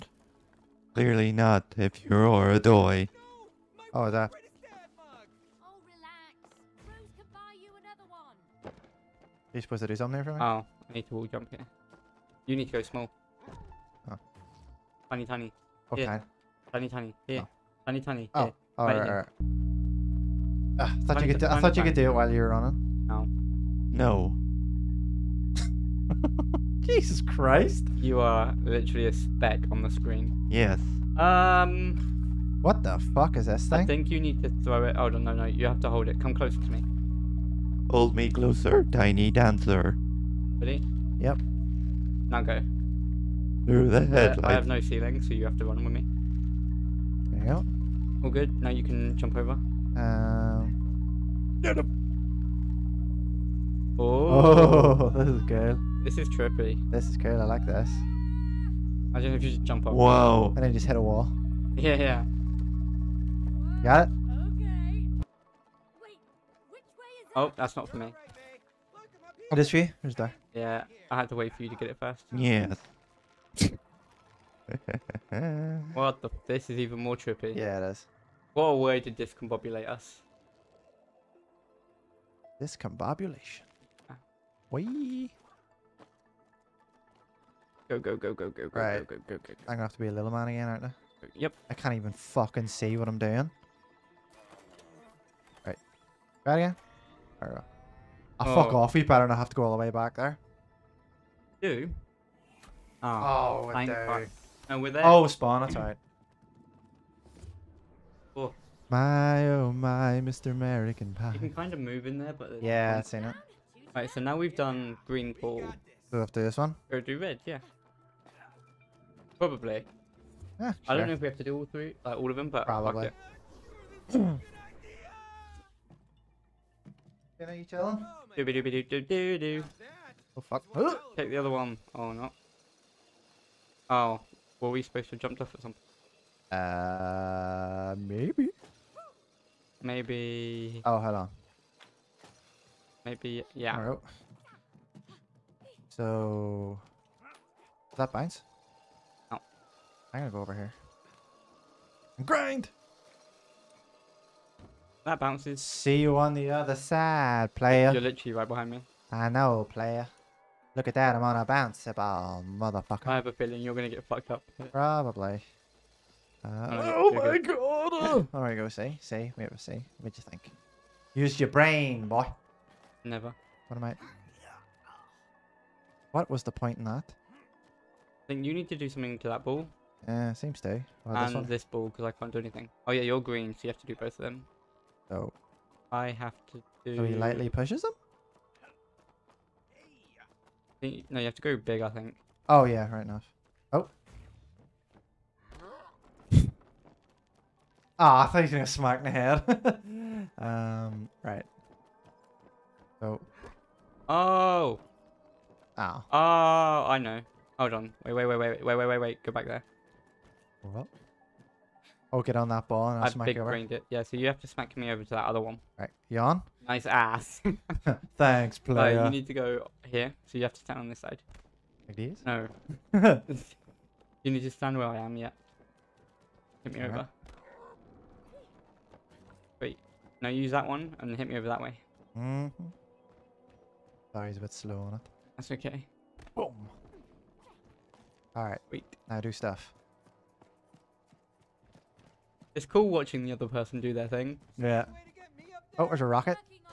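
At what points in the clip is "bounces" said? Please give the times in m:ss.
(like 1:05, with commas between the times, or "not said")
2:35, 2:41.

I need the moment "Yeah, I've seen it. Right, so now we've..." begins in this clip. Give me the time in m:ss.
1:52.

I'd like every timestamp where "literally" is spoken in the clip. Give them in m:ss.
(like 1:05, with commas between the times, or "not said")
0:28, 2:38.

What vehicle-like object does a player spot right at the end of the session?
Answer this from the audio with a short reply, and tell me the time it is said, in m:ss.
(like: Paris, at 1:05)
Rocket, at 4:06.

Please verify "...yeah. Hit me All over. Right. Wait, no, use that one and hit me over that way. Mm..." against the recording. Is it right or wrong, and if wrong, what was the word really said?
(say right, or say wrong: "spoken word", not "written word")
right.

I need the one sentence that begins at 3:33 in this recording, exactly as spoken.
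Yeah, so you have to smack me over to that other one.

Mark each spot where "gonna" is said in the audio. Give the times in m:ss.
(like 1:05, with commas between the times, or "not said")
2:30, 2:43, 3:18.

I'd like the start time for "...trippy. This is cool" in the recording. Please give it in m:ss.
0:56.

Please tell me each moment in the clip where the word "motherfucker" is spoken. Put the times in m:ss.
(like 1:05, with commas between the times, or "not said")
2:42.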